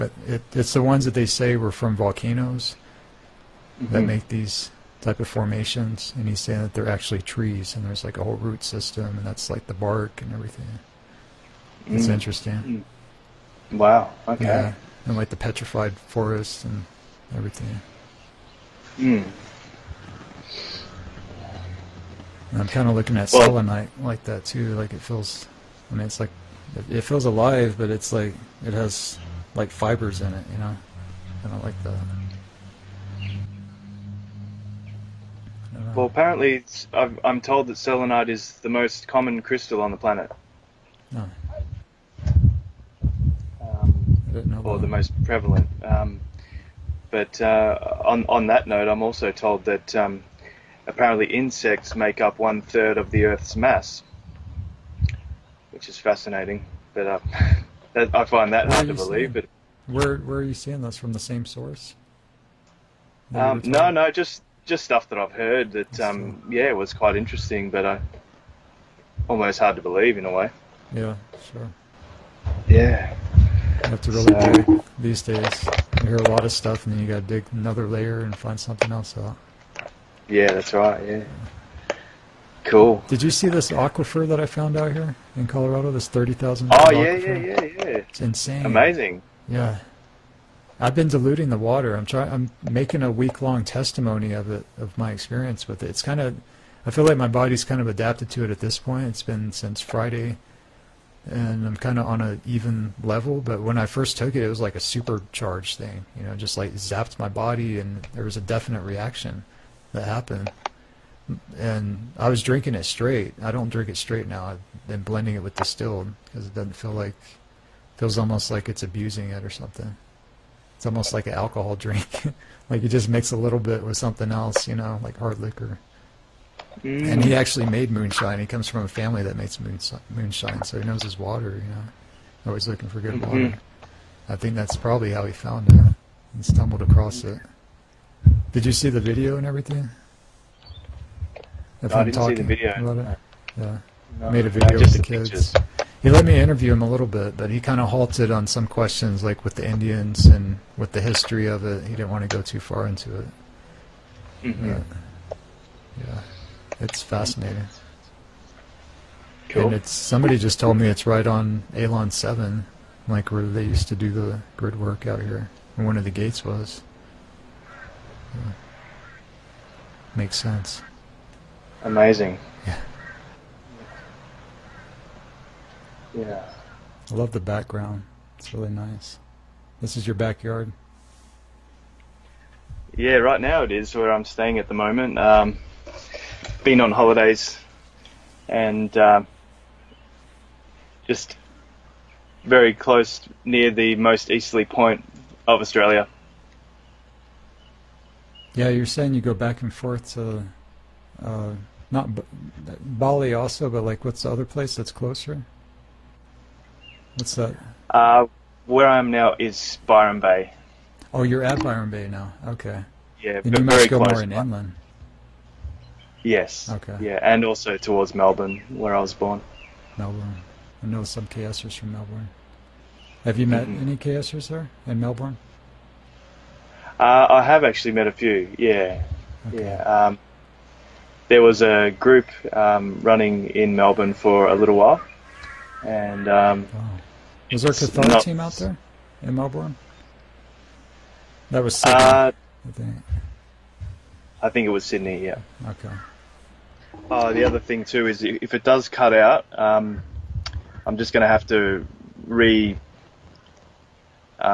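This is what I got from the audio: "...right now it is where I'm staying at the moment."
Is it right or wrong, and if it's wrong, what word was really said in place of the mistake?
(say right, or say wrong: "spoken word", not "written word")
right.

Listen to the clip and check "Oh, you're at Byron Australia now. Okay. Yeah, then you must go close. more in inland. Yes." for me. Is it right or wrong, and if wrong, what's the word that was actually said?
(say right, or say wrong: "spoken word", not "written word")
wrong: "Bay", not "Australia".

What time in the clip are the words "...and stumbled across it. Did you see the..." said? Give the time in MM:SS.
02:16.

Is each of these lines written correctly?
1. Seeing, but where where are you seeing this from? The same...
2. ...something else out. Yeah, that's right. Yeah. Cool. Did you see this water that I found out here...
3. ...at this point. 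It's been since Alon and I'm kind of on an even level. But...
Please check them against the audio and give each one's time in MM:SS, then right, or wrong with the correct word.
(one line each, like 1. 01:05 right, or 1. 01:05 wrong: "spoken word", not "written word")
1. 00:59 right
2. 01:18 wrong: "aquifer", not "water"
3. 01:38 wrong: "Friday", not "Alon".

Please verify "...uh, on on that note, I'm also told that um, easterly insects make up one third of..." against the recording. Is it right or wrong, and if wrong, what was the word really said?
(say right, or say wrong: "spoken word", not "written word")
wrong: "apparently", not "easterly".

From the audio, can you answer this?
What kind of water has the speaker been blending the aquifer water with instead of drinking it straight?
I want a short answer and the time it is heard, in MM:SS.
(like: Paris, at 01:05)
Distilled, at 01:55.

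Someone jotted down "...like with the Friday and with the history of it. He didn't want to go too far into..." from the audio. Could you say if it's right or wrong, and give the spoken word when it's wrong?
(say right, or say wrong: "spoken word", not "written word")
wrong: "Indians", not "Friday".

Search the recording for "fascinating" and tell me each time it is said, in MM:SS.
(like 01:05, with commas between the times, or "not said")
00:55, 02:37.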